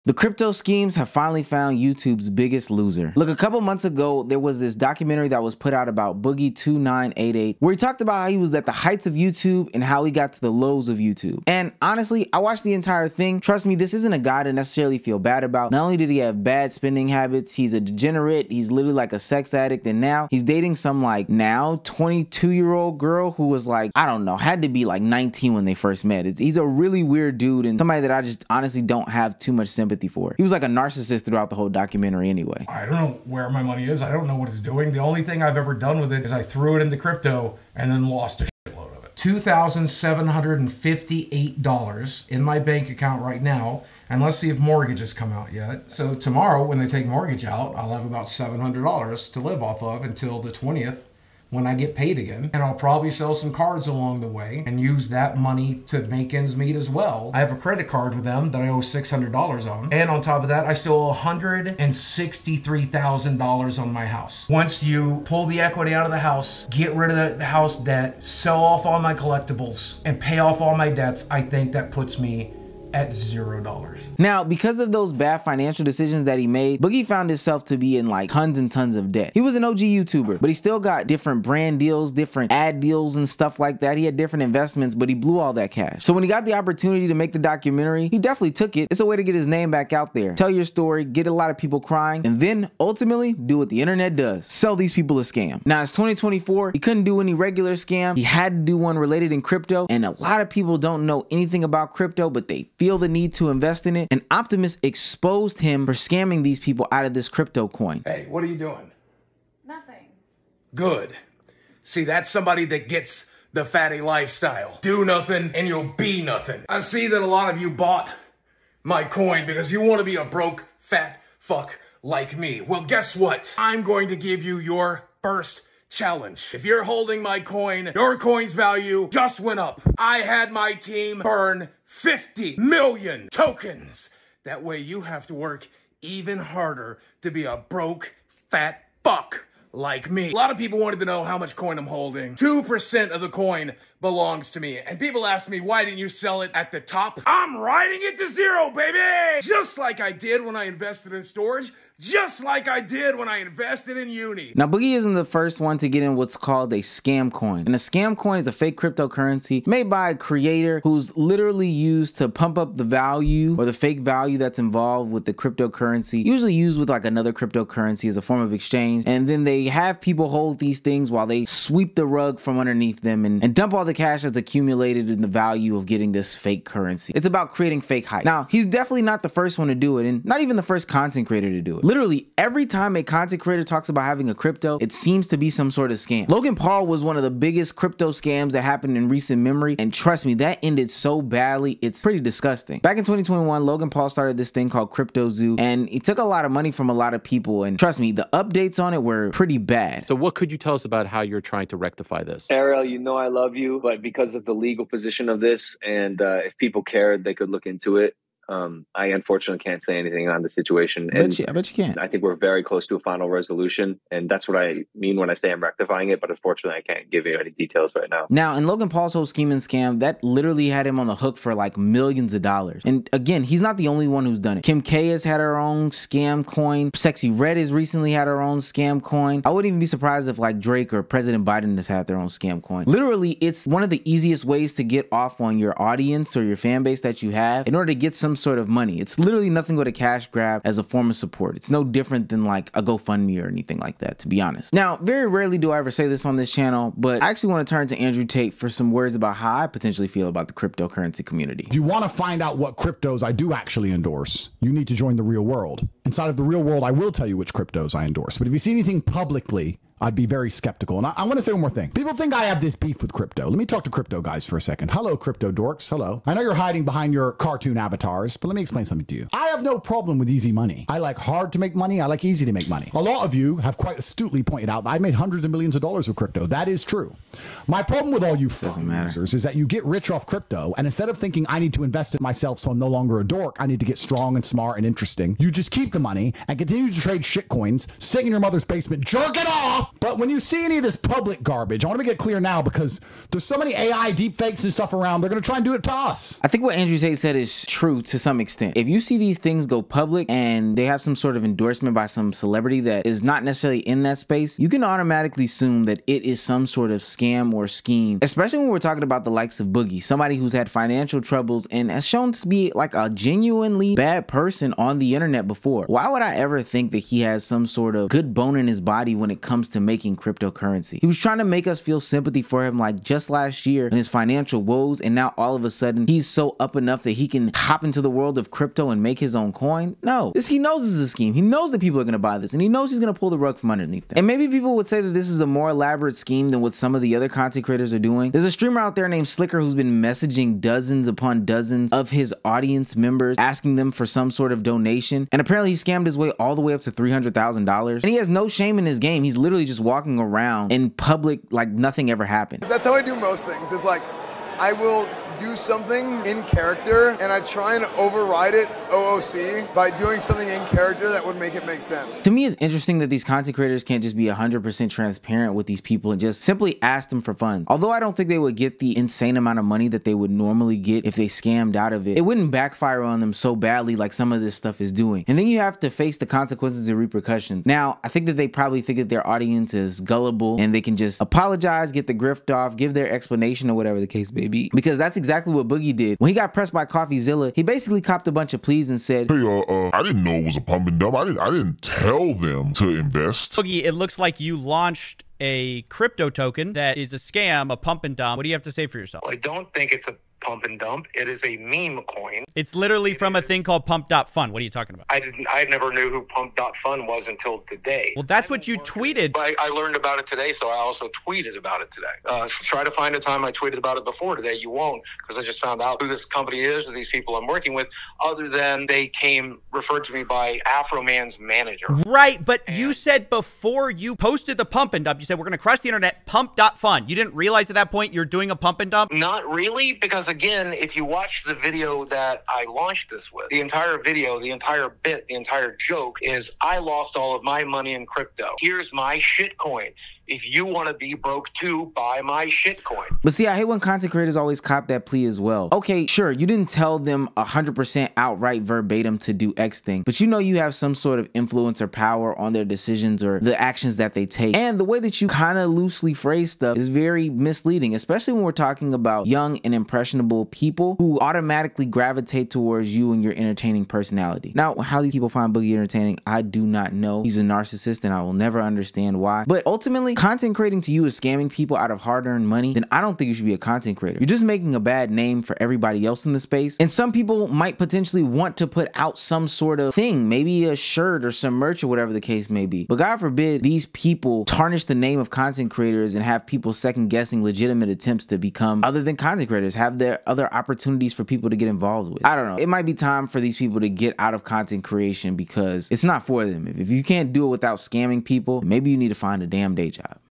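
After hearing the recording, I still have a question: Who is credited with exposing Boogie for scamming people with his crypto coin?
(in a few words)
Optimus.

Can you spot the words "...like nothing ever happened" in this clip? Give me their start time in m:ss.
5:51.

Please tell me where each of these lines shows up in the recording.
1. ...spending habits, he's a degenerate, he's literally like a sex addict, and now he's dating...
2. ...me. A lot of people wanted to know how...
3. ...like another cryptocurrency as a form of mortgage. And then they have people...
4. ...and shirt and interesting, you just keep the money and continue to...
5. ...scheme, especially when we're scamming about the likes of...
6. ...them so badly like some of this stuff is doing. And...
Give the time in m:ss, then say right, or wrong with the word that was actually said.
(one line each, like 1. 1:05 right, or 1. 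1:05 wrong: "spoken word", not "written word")
1. 0:16 right
2. 2:20 right
3. 2:46 wrong: "exchange", not "mortgage"
4. 4:44 wrong: "smart", not "shirt"
5. 5:07 wrong: "talking", not "scamming"
6. 6:13 right.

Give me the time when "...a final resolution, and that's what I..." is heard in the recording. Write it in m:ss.
3:32.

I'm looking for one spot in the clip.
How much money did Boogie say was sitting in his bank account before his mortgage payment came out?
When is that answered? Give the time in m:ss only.
0:39.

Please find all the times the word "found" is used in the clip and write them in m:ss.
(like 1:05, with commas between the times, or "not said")
0:01, 1:17, 6:55.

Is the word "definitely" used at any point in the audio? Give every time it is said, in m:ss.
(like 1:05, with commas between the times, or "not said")
1:28, 2:58.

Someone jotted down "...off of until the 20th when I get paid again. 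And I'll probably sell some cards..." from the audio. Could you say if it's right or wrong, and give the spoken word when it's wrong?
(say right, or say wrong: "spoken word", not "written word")
right.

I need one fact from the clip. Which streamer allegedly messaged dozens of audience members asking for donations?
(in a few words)
Slicker.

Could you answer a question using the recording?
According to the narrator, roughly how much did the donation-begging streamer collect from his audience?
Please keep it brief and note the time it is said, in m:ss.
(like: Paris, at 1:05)
$300,000, at 5:46.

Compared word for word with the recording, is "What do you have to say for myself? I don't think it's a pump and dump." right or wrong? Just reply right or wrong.
wrong.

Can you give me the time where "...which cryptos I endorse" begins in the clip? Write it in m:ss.
4:17.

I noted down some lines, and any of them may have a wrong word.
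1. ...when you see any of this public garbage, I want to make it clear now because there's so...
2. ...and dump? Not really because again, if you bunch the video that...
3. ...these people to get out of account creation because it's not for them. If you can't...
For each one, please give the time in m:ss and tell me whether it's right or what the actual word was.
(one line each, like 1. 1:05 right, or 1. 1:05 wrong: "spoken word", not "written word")
1. 4:50 right
2. 7:08 wrong: "watch", not "bunch"
3. 8:13 wrong: "content", not "account".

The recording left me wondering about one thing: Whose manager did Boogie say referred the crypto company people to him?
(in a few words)
Afroman's manager.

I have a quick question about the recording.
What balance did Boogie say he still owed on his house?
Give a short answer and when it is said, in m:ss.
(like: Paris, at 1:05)
$163,000, at 1:01.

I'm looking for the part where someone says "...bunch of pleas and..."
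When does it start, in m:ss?
6:28.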